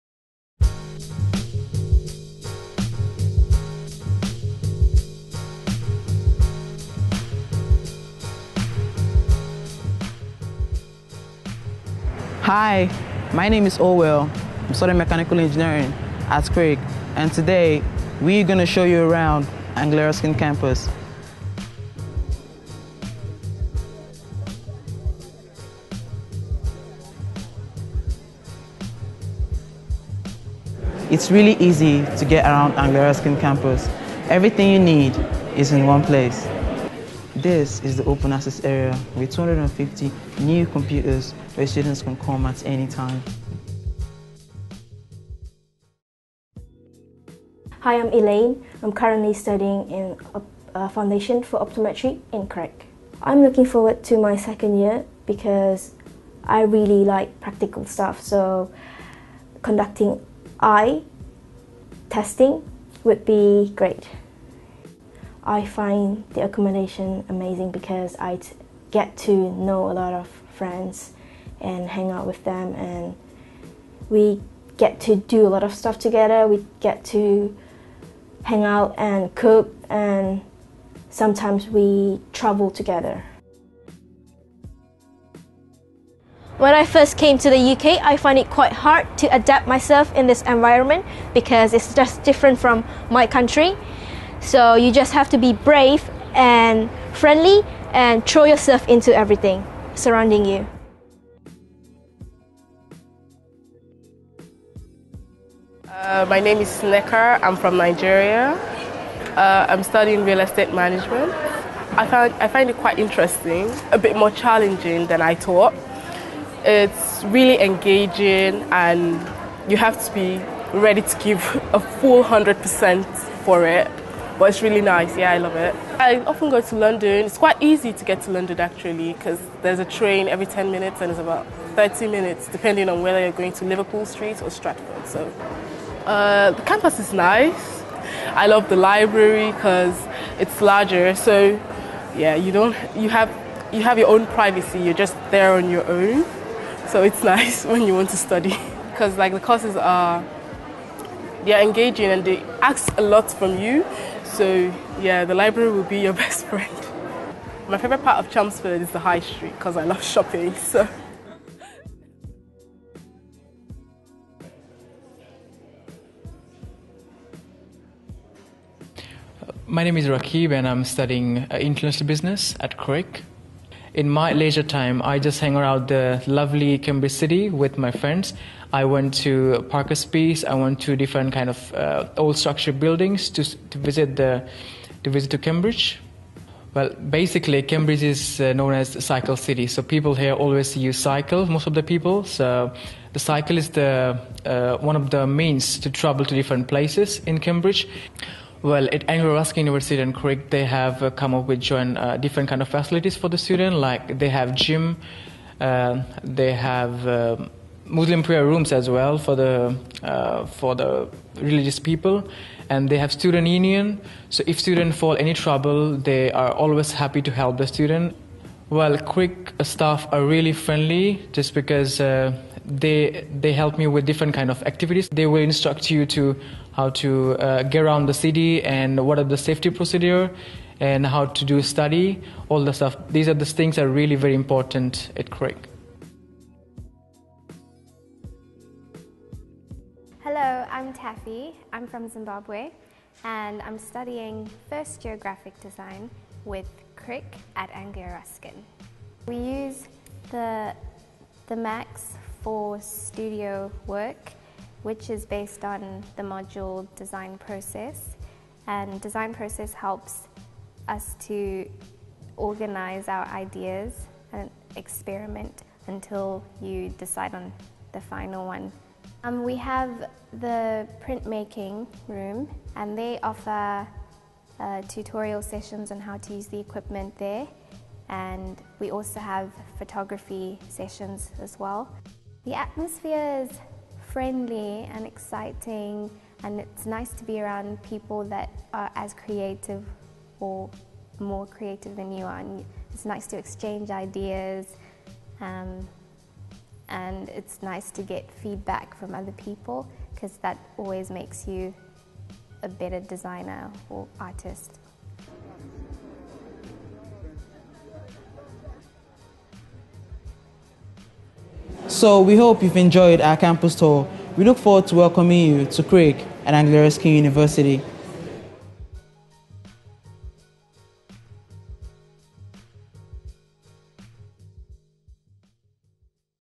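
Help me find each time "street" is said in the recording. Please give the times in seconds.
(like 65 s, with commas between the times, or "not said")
134 s, 159 s.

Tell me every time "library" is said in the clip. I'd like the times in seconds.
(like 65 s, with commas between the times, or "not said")
138 s, 155 s.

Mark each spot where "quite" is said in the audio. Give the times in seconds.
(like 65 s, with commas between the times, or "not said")
88 s, 112 s, 127 s.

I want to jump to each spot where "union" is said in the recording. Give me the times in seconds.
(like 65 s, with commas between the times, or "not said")
213 s.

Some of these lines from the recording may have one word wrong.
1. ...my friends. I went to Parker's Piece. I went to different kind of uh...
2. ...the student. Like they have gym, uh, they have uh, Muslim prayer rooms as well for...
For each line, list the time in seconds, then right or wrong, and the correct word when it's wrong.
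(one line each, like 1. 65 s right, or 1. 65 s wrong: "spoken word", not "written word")
1. 177 s right
2. 203 s right.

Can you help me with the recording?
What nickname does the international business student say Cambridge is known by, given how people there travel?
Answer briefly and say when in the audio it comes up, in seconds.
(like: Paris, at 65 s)
Cycle city, at 189 s.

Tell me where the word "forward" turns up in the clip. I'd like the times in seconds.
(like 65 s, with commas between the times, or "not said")
53 s, 314 s.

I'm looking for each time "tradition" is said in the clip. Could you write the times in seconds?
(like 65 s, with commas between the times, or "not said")
not said.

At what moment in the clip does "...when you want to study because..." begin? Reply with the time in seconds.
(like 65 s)
147 s.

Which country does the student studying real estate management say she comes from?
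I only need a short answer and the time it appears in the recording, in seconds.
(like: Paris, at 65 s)
Nigeria, at 107 s.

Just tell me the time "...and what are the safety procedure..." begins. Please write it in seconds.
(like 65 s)
228 s.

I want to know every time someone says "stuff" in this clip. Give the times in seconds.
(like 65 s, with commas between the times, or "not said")
57 s, 75 s, 232 s.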